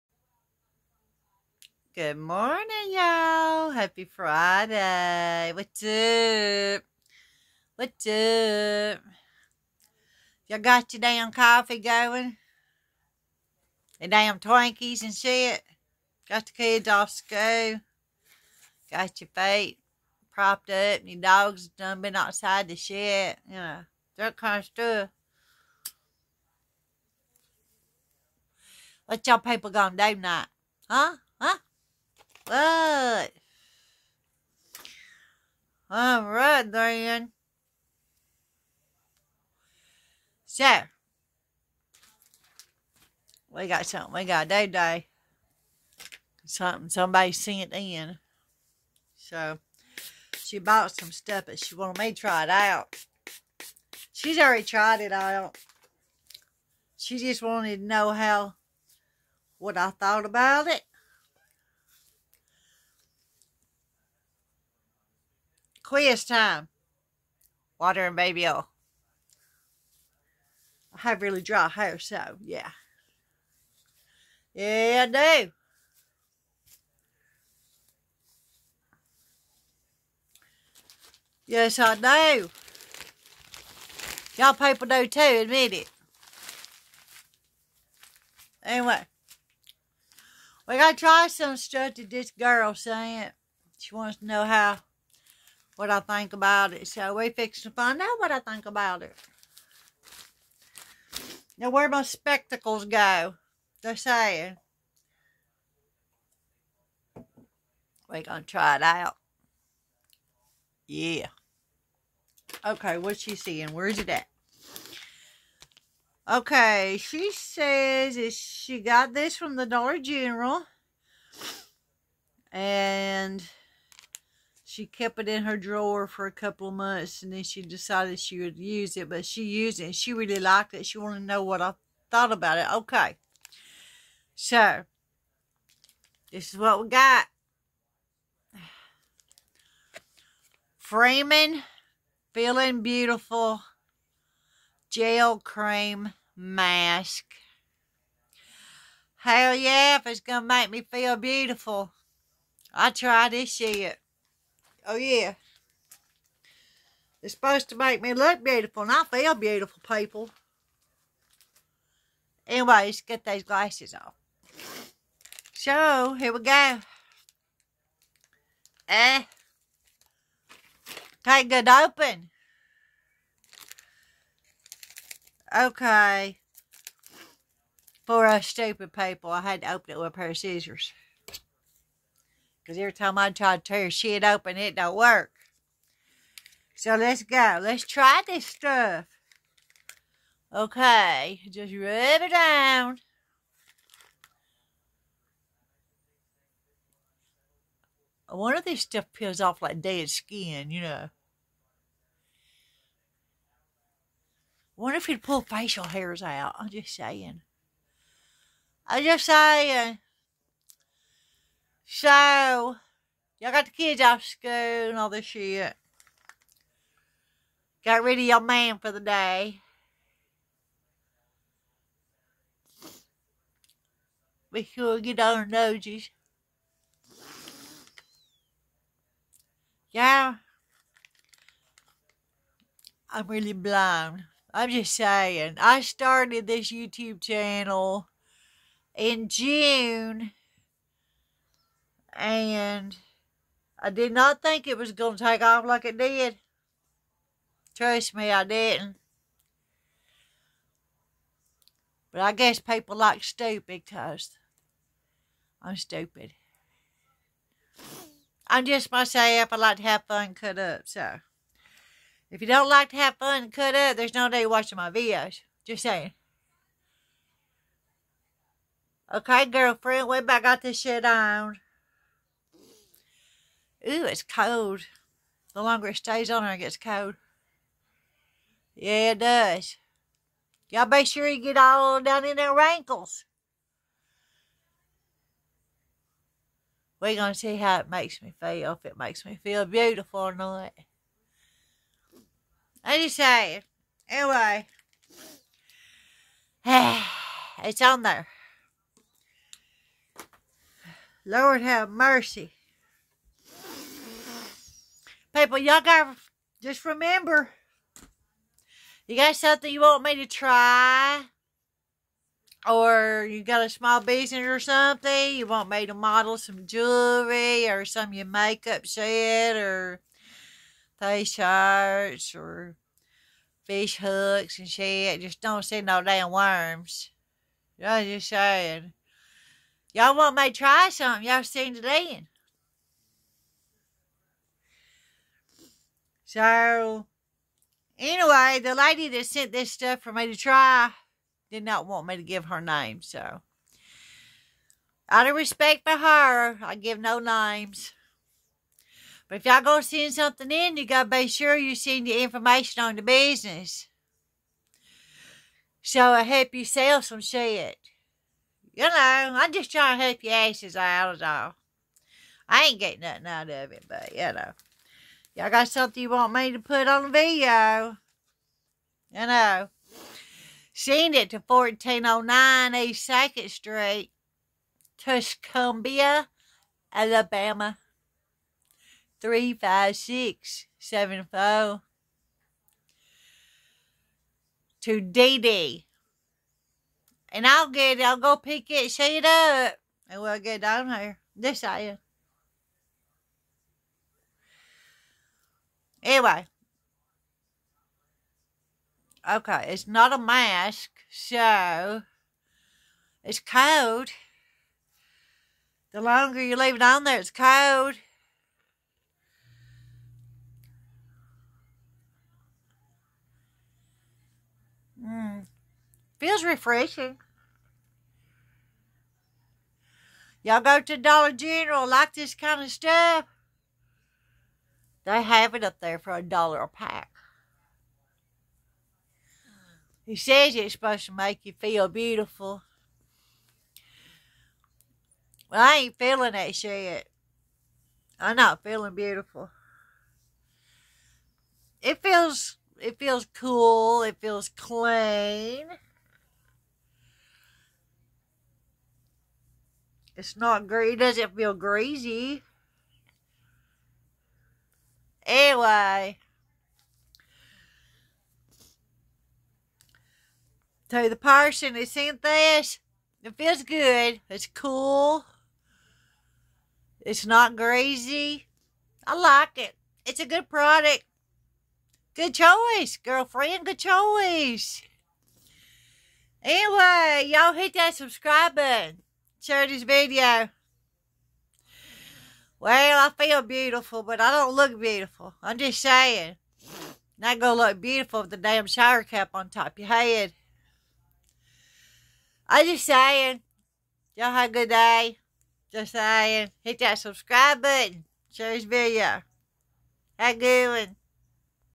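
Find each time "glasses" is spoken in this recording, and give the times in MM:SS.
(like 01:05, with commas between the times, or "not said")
02:43.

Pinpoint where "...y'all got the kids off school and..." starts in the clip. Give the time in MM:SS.
03:33.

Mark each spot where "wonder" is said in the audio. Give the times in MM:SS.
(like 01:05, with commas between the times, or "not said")
03:18, 03:24.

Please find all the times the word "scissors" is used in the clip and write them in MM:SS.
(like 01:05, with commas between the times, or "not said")
03:00.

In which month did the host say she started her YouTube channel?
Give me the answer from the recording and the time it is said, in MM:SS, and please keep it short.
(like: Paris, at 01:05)
June, at 03:59.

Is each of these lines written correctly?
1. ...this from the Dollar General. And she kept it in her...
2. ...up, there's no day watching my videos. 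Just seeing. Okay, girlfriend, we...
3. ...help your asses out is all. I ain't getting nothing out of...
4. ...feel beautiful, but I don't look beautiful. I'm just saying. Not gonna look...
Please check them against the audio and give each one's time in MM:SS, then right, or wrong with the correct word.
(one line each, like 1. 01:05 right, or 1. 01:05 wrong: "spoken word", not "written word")
1. 01:59 right
2. 04:23 wrong: "saying", not "seeing"
3. 06:00 right
4. 08:03 right.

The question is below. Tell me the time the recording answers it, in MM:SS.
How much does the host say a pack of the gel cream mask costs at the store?
07:06.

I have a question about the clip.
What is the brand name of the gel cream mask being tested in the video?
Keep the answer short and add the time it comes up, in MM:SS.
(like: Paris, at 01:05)
Freeman, at 02:20.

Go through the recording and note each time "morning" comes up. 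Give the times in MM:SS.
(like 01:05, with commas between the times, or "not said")
00:02.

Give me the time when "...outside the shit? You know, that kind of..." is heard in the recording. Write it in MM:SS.
00:22.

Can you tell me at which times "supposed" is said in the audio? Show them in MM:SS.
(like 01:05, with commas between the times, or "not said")
02:37, 07:10.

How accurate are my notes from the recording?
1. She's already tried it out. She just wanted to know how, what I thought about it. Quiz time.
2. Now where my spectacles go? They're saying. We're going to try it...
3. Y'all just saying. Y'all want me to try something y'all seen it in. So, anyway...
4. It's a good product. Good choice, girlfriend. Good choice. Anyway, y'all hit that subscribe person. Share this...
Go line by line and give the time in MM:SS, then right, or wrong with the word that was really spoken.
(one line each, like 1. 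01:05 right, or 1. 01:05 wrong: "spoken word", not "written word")
1. 00:54 right
2. 01:41 right
3. 05:27 right
4. 07:50 wrong: "button", not "person".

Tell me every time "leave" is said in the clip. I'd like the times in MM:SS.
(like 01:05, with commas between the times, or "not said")
06:46.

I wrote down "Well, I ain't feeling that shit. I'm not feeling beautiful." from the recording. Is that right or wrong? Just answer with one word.
right.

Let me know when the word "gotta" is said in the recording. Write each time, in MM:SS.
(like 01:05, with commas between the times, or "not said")
01:30, 05:50.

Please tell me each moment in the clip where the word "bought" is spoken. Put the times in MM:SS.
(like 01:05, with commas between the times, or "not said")
00:50.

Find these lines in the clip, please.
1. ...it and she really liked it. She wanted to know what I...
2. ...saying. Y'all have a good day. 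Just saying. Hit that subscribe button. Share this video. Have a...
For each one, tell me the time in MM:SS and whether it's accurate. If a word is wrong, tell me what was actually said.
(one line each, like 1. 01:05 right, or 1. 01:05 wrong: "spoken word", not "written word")
1. 02:09 right
2. 08:12 right.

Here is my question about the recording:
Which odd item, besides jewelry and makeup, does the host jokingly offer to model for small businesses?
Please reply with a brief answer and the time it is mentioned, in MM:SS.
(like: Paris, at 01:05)
Fish hooks, at 05:23.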